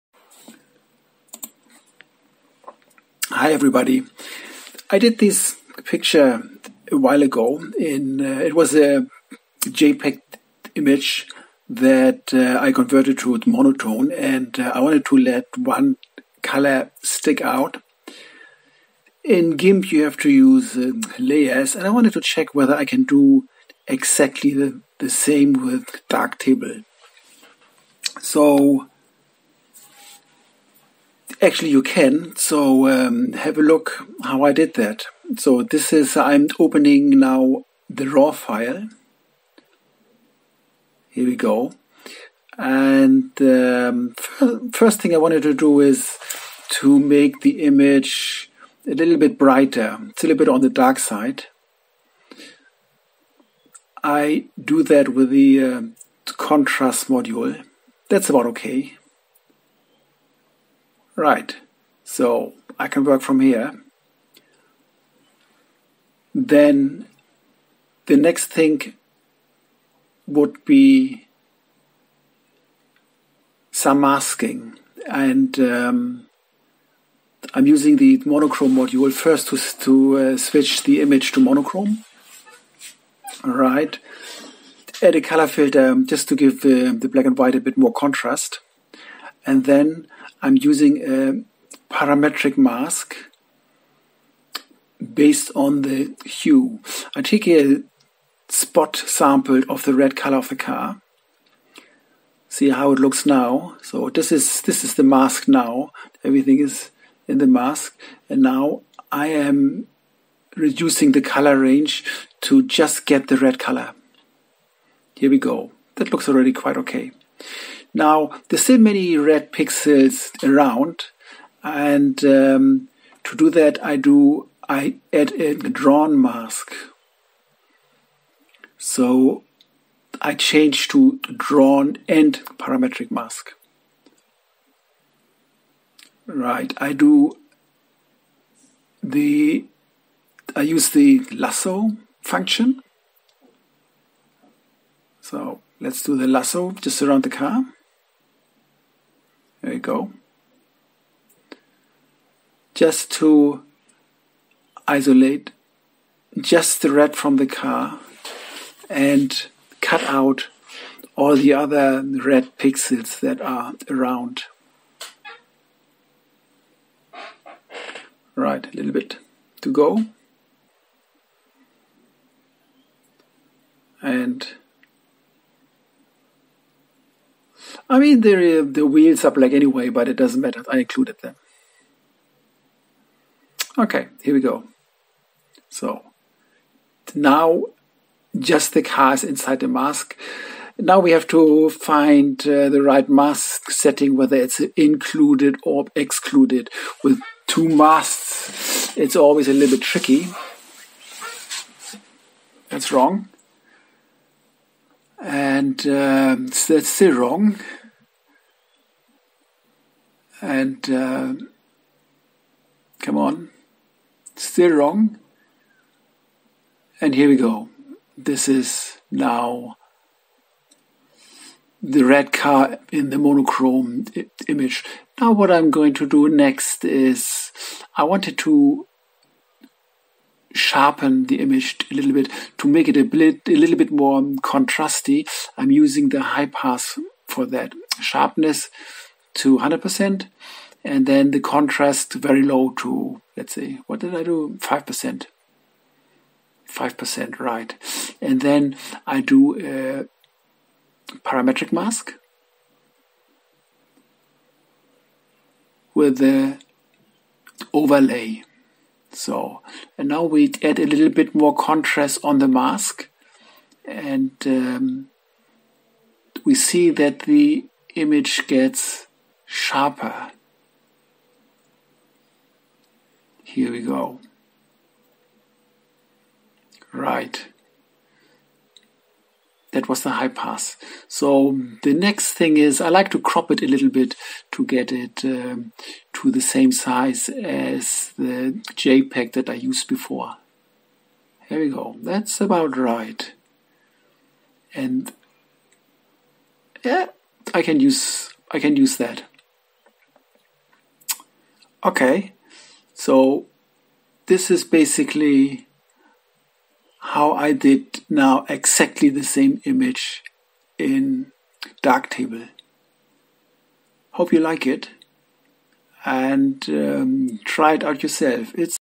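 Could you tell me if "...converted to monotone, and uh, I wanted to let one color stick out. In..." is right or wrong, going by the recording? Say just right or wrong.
right.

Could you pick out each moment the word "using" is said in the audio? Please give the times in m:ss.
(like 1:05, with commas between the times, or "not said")
1:17, 1:30, 3:55.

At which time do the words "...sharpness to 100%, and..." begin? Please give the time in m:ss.
3:57.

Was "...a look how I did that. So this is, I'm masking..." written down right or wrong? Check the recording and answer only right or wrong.
wrong.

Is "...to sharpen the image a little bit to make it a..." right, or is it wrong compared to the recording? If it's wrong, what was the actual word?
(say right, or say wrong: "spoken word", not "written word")
right.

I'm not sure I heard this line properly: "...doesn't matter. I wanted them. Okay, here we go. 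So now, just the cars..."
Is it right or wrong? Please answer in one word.
wrong.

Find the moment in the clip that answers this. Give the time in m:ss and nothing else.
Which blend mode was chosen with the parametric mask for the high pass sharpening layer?
4:17.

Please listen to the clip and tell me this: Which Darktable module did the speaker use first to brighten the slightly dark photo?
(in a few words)
contrast module.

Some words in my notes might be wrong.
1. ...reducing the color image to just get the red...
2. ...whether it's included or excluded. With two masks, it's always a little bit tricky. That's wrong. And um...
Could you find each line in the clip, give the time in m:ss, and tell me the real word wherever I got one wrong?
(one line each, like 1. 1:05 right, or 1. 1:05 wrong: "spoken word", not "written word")
1. 1:50 wrong: "range", not "image"
2. 3:14 right.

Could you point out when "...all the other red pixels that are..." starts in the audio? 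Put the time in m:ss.
2:41.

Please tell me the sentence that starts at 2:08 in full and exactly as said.
So I change to drawn and parametric mask.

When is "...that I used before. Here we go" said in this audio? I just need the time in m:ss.
4:49.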